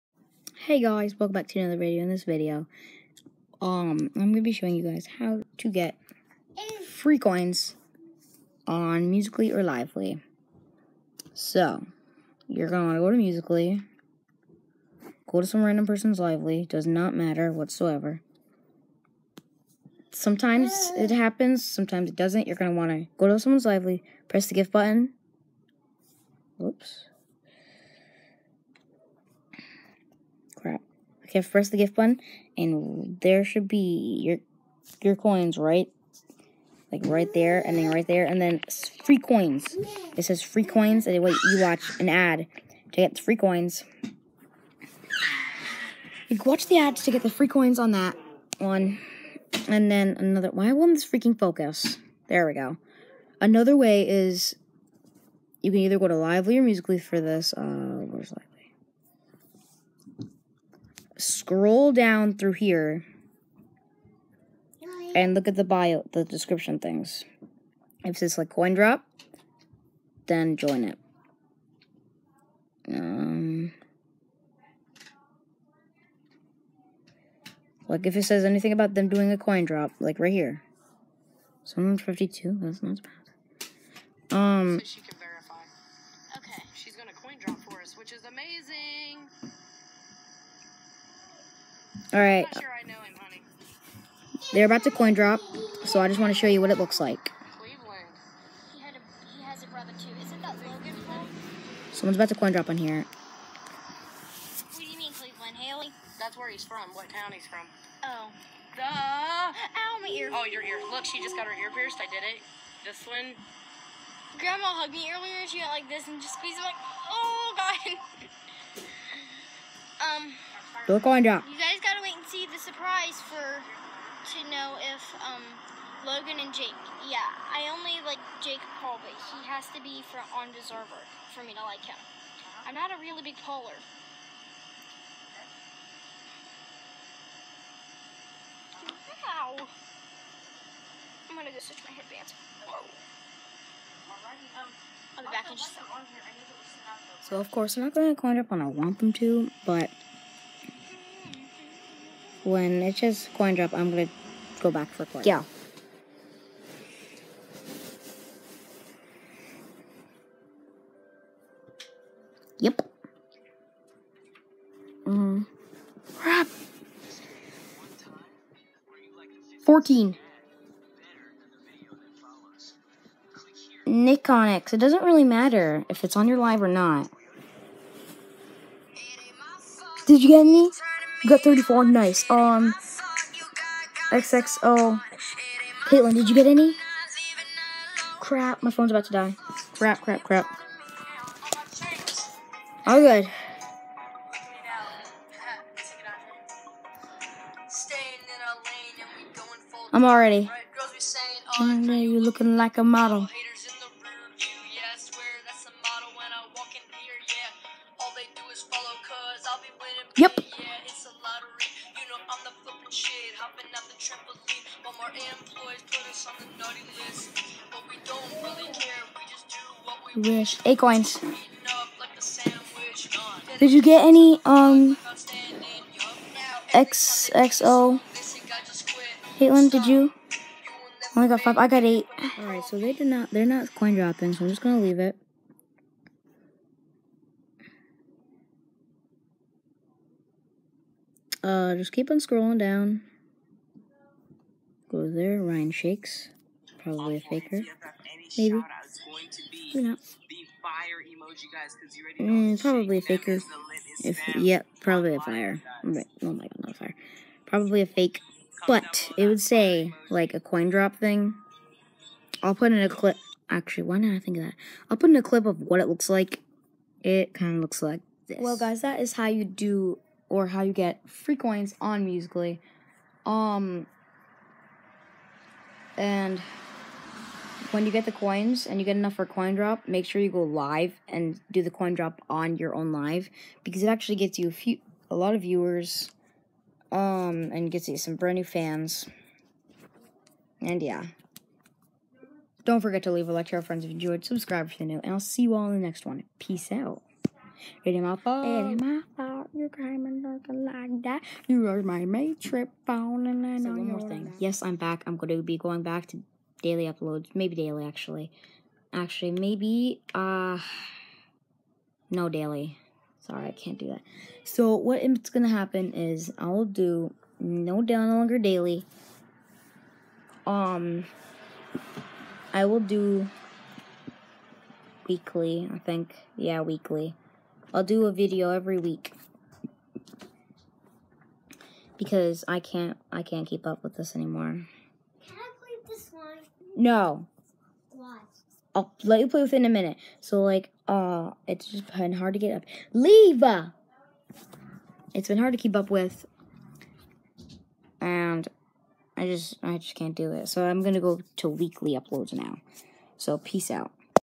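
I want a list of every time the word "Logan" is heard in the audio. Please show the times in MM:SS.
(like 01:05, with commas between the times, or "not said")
02:06.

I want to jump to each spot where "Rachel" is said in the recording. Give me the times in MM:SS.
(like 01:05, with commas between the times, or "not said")
not said.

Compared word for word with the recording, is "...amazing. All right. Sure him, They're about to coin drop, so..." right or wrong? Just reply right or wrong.
right.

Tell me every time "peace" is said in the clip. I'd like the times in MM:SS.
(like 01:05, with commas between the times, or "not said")
04:56, 05:53.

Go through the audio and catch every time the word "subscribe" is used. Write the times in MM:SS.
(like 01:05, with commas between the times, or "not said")
04:54.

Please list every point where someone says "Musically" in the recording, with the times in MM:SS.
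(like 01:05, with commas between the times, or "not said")
00:09, 00:13, 00:56, 04:32.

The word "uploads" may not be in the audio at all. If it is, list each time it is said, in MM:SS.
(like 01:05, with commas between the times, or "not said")
05:06, 05:51.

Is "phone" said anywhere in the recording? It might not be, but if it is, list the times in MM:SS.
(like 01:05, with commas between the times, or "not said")
03:08, 05:02.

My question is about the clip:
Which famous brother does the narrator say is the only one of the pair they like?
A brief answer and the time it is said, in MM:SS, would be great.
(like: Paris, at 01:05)
Jake Paul, at 02:08.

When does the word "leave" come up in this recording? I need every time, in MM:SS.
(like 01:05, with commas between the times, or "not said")
03:54, 04:53, 05:42.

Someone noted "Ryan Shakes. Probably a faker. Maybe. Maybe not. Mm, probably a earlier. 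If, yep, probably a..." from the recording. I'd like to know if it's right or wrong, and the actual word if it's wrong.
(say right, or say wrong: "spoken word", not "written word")
wrong: "faker", not "earlier".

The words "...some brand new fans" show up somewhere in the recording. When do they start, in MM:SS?
04:47.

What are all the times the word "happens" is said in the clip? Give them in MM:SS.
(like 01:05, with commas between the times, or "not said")
00:21, 05:15.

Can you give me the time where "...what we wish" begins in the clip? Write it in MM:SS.
03:39.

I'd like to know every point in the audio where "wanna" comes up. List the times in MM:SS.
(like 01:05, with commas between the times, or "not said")
00:12, 00:22.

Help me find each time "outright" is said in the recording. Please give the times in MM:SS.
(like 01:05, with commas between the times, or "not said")
not said.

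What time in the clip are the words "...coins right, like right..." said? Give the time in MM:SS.
00:35.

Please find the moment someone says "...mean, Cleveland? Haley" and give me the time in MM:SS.
01:44.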